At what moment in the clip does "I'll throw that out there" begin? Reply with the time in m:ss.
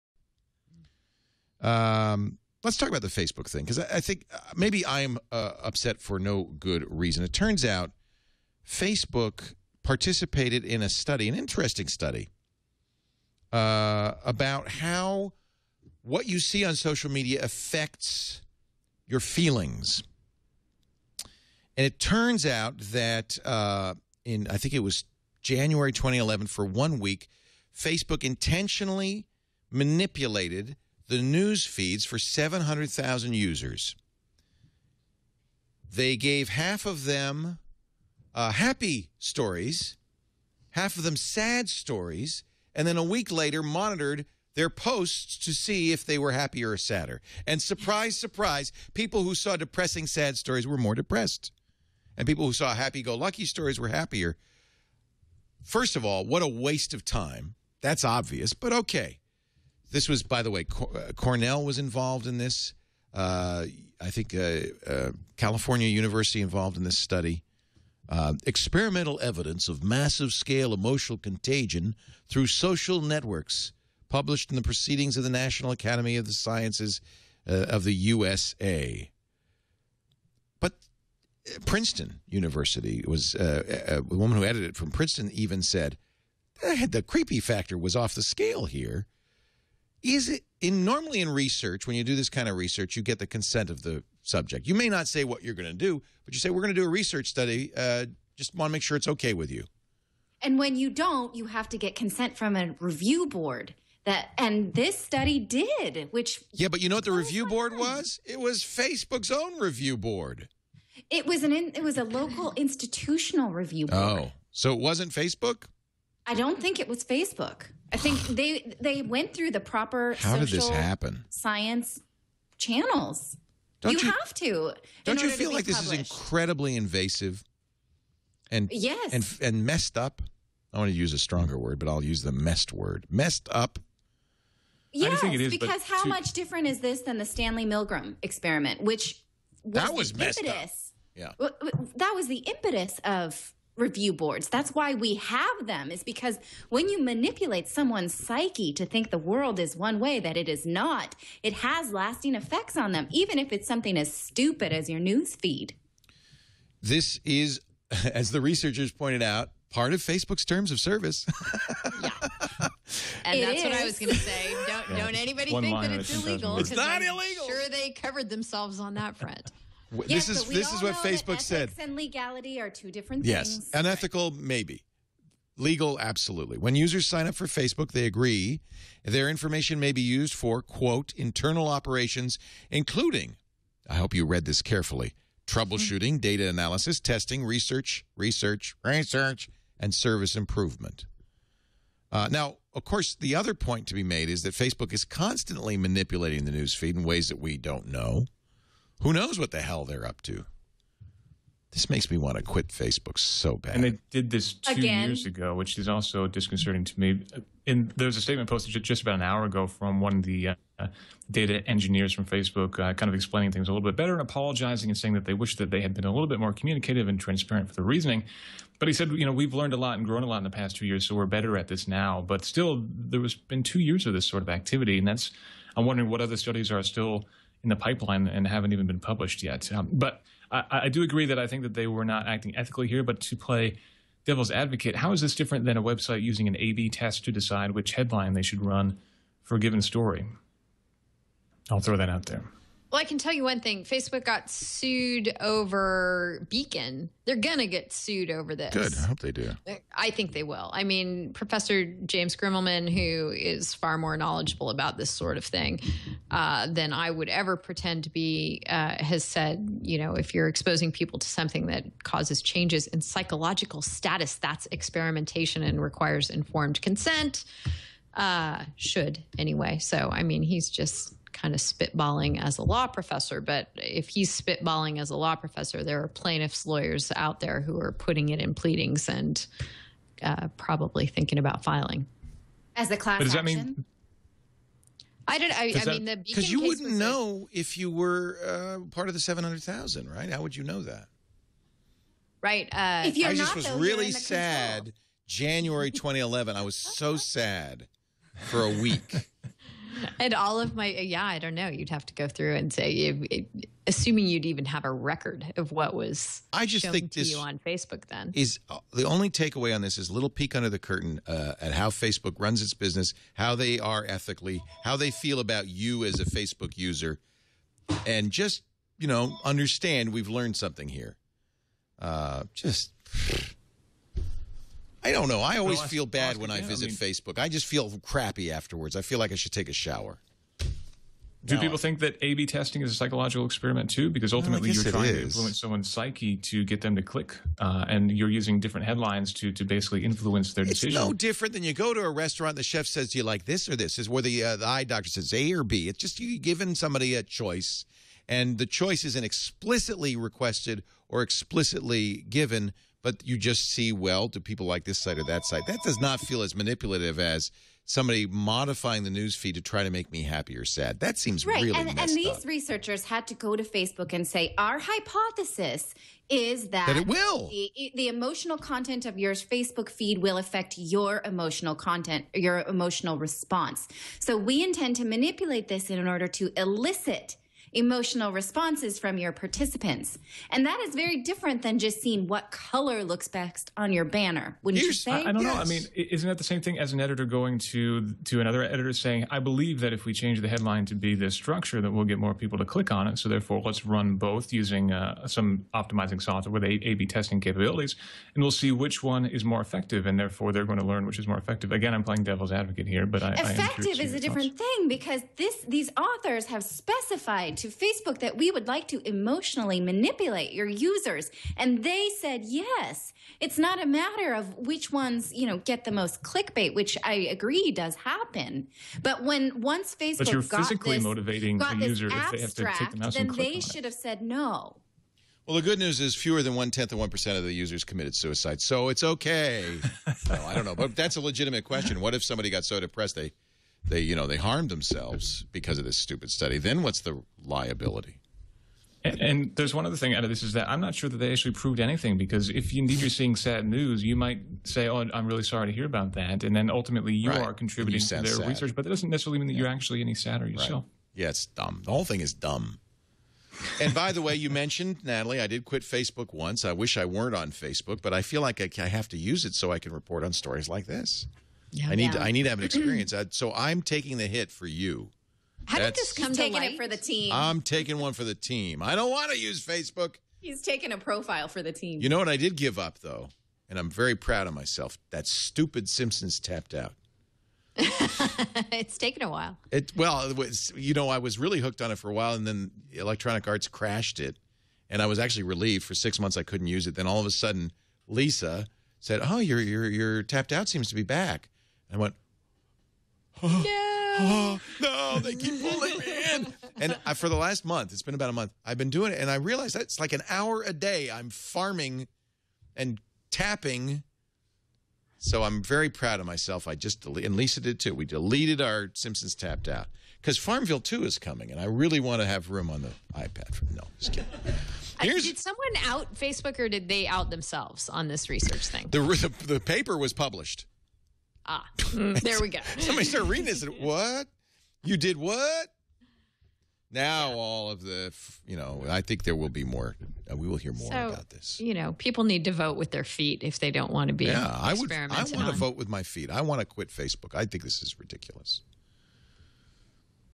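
4:01.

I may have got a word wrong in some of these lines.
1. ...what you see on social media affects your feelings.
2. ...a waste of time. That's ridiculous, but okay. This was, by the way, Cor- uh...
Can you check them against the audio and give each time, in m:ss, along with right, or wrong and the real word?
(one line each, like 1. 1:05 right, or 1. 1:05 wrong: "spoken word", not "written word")
1. 0:16 right
2. 0:56 wrong: "obvious", not "ridiculous".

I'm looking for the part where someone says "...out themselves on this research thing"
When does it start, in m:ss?
8:37.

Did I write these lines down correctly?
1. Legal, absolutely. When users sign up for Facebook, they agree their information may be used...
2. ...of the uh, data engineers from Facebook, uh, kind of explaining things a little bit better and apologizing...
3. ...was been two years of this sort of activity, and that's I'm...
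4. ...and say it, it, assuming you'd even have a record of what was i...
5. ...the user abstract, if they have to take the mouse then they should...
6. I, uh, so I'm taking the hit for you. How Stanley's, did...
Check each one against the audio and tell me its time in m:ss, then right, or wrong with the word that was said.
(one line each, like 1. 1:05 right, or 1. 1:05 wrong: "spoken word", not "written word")
1. 2:55 right
2. 3:30 right
3. 3:43 right
4. 5:02 right
5. 7:01 right
6. 7:43 wrong: "That", not "Stanley".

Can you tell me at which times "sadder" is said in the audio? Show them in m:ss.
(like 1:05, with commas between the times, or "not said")
0:46, 7:30.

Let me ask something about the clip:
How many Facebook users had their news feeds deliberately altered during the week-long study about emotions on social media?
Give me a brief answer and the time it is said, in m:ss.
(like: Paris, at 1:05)
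700,000, at 0:32.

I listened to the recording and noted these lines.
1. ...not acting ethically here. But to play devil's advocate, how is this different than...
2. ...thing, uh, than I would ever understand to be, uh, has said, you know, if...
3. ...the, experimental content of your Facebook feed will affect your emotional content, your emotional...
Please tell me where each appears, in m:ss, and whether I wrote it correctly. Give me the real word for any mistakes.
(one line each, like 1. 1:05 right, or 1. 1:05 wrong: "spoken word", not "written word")
1. 3:52 right
2. 4:15 wrong: "pretend", not "understand"
3. 6:07 wrong: "emotional", not "experimental".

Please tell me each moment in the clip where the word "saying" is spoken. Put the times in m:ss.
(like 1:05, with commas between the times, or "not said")
3:34, 6:28.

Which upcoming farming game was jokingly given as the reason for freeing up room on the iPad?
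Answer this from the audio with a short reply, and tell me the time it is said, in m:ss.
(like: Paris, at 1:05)
Farmville 2, at 8:30.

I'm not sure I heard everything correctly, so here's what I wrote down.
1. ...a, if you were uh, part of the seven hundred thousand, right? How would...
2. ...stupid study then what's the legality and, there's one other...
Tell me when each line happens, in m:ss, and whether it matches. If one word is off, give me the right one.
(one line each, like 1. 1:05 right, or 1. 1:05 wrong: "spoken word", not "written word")
1. 4:47 right
2. 7:15 wrong: "liability", not "legality".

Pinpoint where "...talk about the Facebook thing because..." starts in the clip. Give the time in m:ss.
0:02.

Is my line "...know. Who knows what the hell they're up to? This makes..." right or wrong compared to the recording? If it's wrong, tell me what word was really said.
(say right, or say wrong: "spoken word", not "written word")
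right.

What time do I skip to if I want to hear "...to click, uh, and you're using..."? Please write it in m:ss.
5:36.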